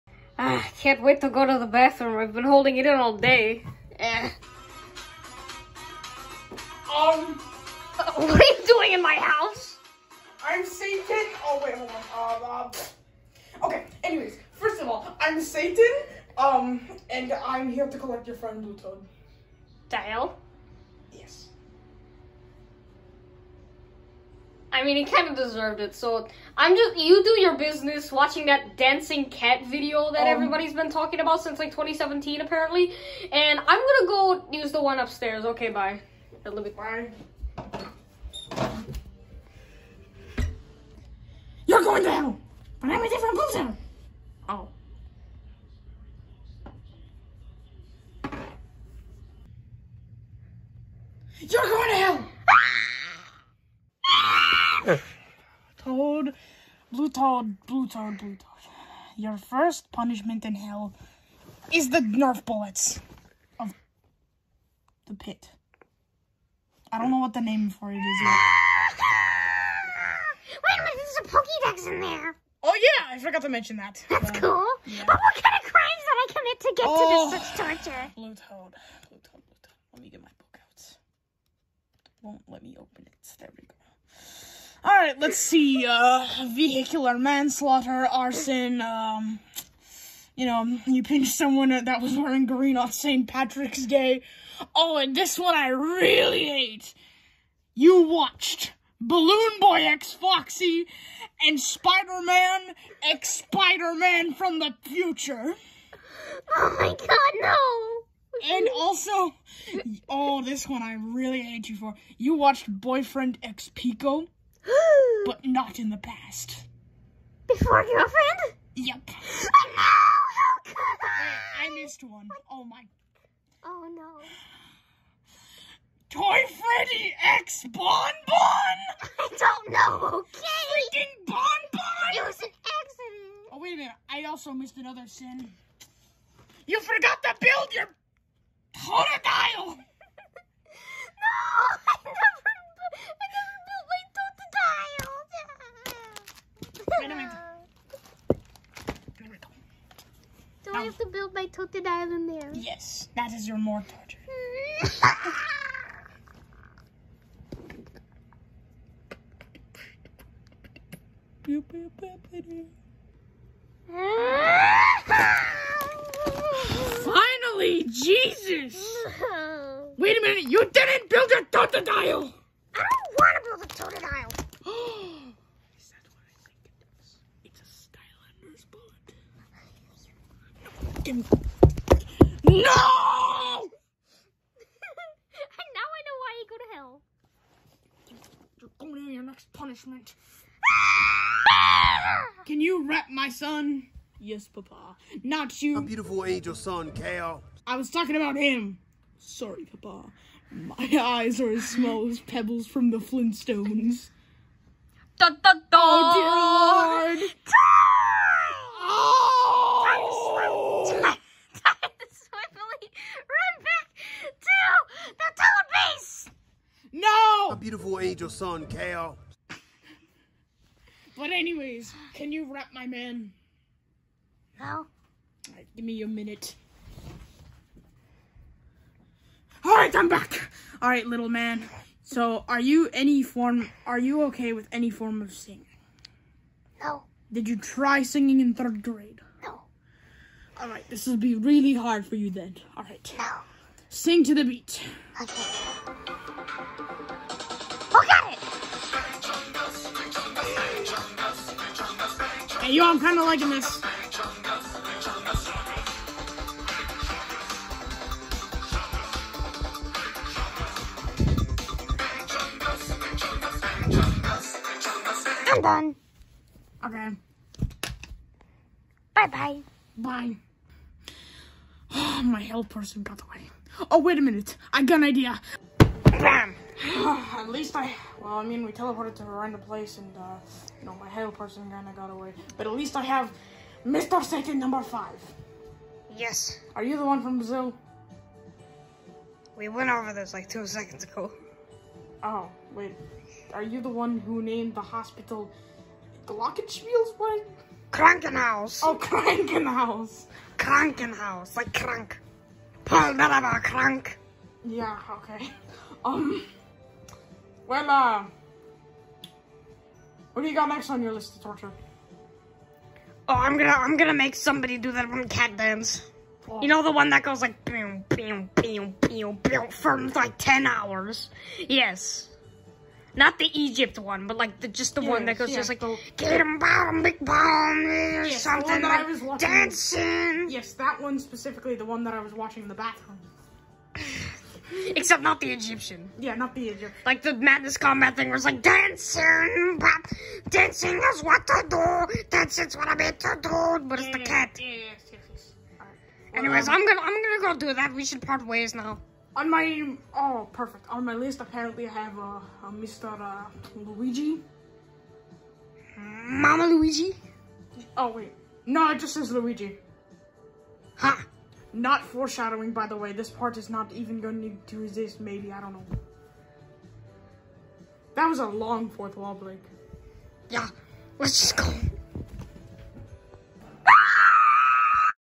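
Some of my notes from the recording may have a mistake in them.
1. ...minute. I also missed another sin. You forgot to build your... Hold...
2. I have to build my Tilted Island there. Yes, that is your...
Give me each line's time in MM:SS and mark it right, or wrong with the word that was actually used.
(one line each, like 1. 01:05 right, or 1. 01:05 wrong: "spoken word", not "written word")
1. 02:13 right
2. 02:30 right.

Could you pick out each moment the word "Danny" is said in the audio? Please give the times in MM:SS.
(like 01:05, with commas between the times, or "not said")
not said.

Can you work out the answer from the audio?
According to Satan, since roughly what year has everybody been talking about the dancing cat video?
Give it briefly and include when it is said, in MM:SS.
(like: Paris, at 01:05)
2017, at 00:31.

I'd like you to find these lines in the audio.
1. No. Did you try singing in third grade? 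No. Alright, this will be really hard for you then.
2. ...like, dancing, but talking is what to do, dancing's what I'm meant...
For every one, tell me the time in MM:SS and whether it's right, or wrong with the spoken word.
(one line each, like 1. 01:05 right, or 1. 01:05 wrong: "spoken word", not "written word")
1. 03:56 right
2. 05:38 wrong: "dancing", not "talking".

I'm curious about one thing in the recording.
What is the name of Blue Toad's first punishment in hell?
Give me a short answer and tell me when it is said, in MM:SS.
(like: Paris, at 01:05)
Nerf bullets of the pit, at 01:01.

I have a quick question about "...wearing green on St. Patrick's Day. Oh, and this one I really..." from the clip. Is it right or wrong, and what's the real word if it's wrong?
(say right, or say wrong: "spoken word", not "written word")
right.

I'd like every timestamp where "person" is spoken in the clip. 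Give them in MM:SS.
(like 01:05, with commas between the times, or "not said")
00:43, 04:32, 04:41.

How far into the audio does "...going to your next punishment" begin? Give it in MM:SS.
03:08.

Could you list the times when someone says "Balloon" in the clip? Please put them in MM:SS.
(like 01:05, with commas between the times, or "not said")
01:38.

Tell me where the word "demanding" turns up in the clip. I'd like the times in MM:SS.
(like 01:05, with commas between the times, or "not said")
not said.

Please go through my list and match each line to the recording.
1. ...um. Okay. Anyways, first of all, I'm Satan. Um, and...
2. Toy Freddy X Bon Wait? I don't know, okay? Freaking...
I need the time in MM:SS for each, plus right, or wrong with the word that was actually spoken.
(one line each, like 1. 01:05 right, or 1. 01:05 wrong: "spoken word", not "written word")
1. 00:12 right
2. 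02:06 wrong: "Bon", not "Wait".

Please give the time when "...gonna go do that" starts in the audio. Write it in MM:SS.
05:47.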